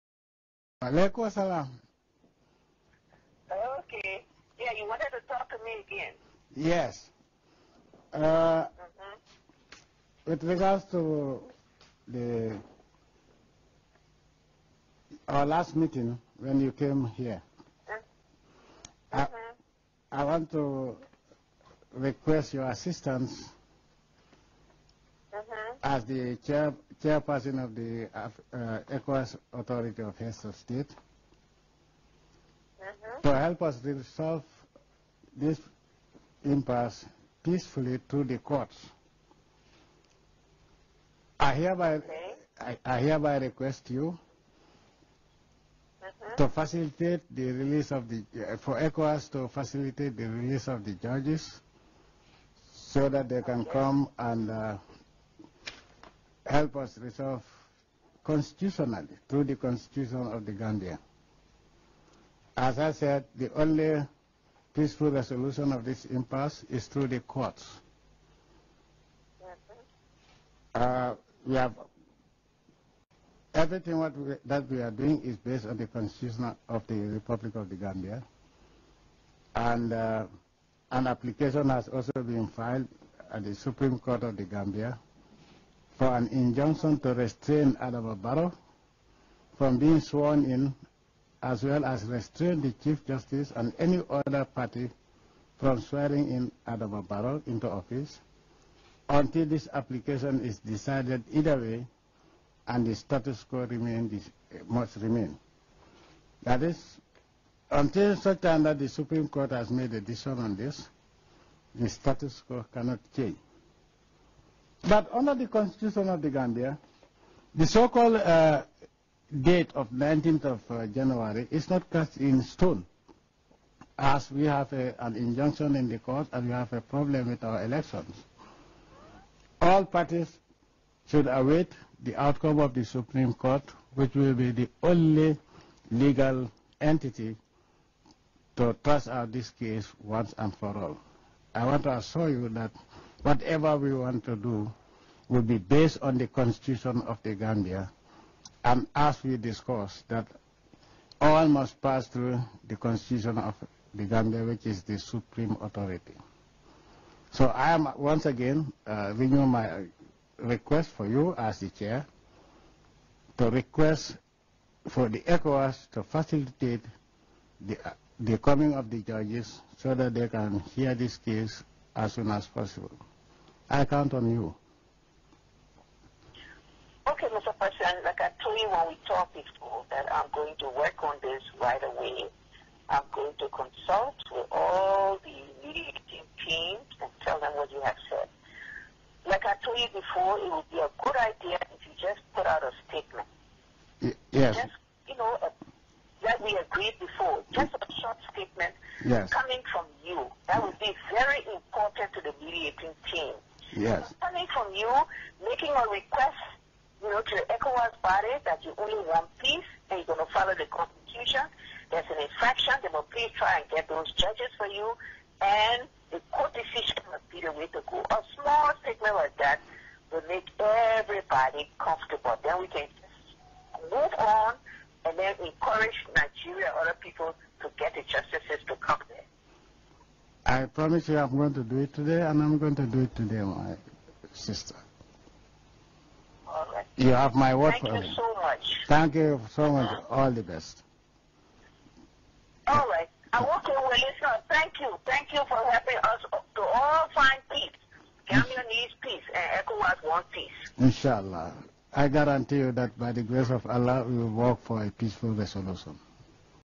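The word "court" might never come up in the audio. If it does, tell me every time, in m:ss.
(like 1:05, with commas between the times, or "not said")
0:38, 1:07, 1:23, 1:49, 2:05, 2:13, 3:36.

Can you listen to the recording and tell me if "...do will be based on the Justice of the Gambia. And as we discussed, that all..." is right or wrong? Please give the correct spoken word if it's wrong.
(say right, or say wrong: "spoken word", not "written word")
wrong: "Constitution", not "Justice".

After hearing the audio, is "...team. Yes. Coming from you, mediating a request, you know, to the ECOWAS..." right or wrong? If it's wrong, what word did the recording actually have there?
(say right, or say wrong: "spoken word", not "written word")
wrong: "making", not "mediating".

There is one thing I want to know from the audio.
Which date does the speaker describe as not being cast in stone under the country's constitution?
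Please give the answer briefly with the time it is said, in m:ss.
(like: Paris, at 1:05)
19 January, at 1:59.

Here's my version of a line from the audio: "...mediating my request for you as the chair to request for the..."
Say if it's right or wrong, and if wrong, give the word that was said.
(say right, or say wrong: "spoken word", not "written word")
wrong: "renewing", not "mediating".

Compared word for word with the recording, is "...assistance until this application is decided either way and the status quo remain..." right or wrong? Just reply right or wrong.
wrong.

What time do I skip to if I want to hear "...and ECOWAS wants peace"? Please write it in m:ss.
4:09.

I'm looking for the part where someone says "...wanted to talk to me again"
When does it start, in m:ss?
0:04.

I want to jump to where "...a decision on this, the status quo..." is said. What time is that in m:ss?
1:49.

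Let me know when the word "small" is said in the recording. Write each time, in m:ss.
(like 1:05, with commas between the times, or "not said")
3:38.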